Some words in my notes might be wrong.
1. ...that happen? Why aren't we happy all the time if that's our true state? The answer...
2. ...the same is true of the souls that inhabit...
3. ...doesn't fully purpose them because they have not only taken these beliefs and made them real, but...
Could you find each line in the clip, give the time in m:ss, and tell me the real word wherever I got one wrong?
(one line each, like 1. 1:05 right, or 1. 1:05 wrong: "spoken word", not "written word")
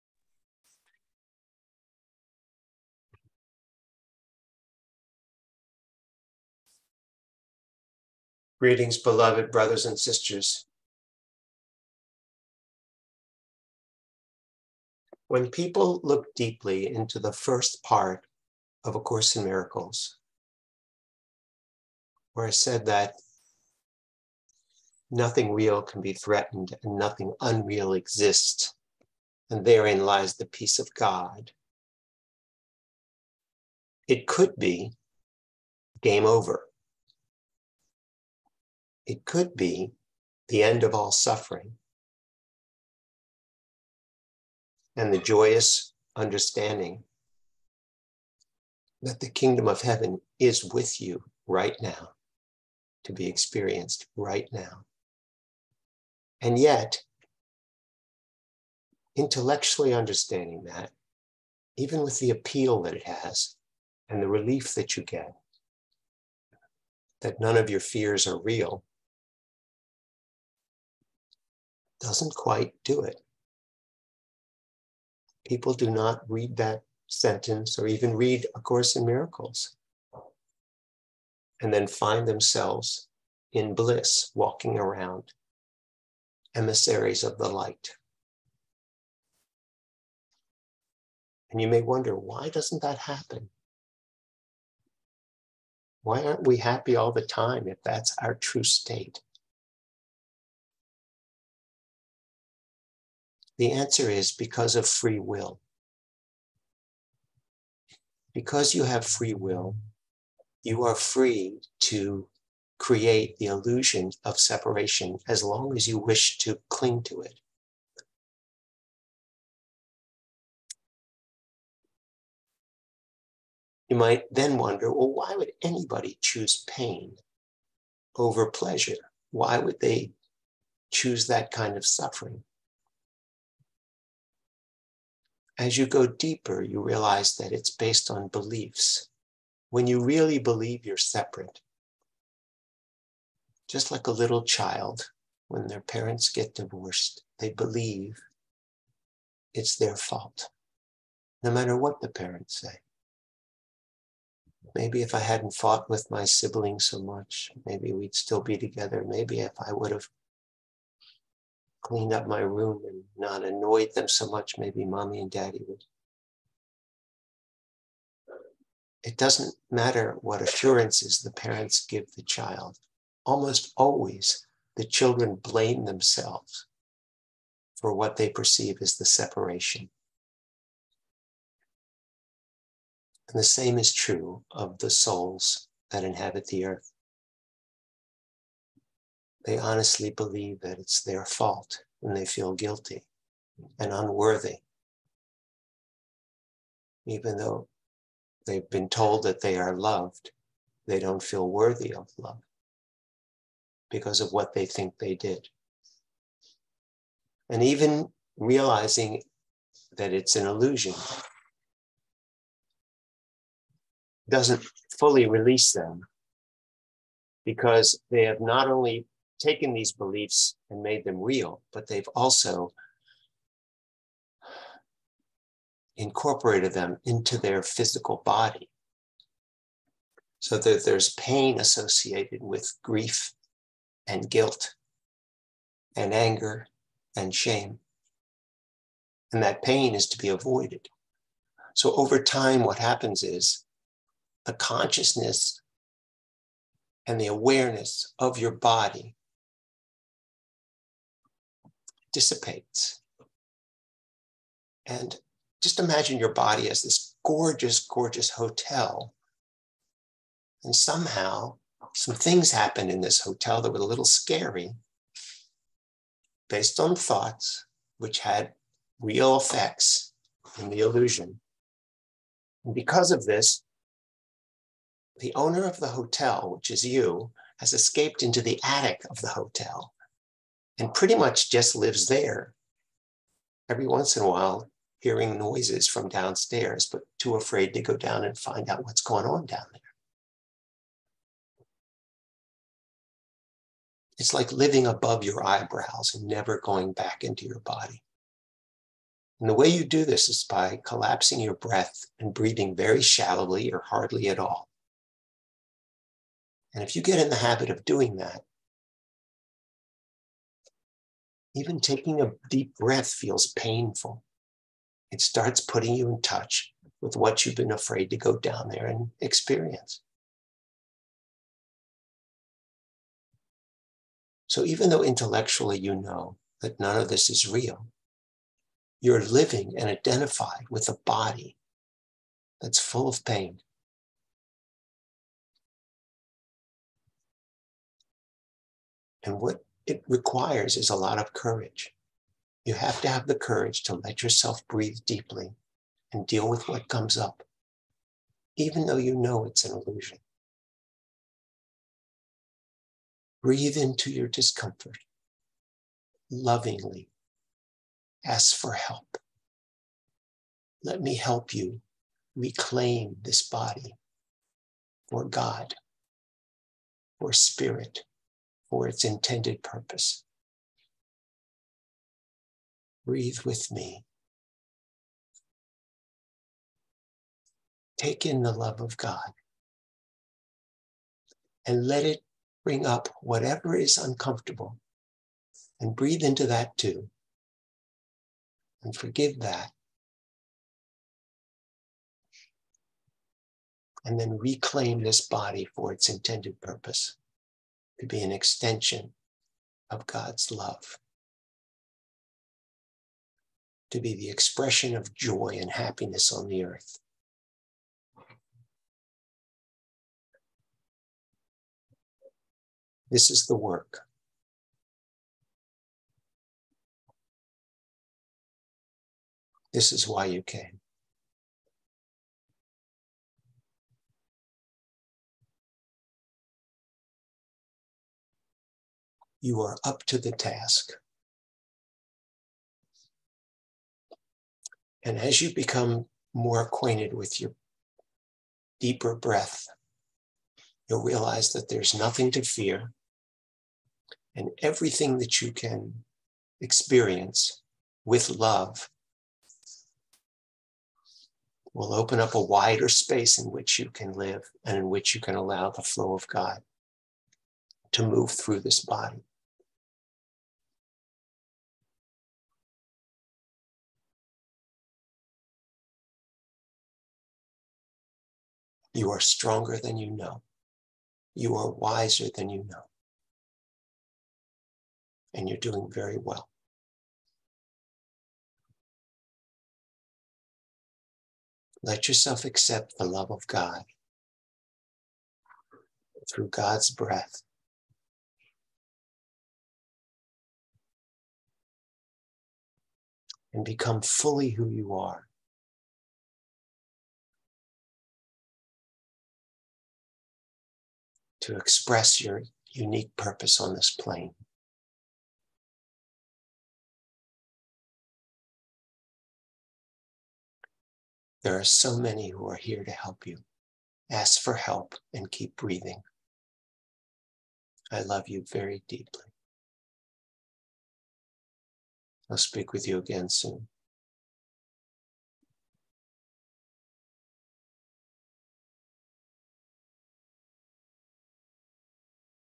1. 1:32 right
2. 3:03 right
3. 3:34 wrong: "release", not "purpose".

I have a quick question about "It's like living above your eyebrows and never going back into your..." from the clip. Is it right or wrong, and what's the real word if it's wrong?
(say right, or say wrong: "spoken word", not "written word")
right.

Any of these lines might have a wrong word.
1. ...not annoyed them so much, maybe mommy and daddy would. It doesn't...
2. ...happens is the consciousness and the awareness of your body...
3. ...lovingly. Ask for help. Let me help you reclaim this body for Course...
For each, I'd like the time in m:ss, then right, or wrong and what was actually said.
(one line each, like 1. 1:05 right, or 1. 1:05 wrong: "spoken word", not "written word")
1. 2:43 right
2. 4:02 right
3. 5:56 wrong: "God", not "Course".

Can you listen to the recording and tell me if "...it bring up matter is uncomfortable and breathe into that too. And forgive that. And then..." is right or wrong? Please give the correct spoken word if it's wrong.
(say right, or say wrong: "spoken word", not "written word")
wrong: "whatever", not "matter".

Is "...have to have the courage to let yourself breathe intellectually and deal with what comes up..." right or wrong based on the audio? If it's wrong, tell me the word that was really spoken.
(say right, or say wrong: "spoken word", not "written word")
wrong: "deeply", not "intellectually".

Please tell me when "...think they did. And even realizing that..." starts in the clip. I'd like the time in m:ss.
3:24.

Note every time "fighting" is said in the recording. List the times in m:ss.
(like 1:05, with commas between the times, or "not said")
not said.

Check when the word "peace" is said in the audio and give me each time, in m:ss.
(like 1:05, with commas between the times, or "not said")
0:30.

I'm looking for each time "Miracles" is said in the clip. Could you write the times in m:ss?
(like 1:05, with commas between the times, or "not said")
0:19, 1:19.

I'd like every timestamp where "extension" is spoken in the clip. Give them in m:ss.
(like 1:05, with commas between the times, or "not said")
6:38.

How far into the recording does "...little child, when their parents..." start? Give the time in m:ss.
2:24.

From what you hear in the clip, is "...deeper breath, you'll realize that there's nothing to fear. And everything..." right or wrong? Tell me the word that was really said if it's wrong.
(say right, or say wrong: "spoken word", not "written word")
right.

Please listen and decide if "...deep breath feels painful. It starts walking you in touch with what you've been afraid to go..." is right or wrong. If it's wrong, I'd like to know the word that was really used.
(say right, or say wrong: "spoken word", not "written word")
wrong: "putting", not "walking".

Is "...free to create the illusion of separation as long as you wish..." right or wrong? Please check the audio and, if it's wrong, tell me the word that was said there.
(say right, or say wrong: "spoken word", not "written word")
right.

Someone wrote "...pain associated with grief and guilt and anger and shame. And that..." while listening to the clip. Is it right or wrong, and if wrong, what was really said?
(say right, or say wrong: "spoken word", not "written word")
right.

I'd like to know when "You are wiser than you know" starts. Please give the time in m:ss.
7:51.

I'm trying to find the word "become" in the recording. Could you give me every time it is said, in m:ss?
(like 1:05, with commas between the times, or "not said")
7:15, 8:13.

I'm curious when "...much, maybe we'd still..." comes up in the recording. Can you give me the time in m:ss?
2:37.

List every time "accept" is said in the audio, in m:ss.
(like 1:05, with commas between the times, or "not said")
8:02.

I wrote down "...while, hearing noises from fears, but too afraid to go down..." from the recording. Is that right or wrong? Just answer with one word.
wrong.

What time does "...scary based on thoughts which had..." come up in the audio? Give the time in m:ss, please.
4:24.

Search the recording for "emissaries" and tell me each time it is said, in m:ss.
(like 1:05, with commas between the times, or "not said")
1:26.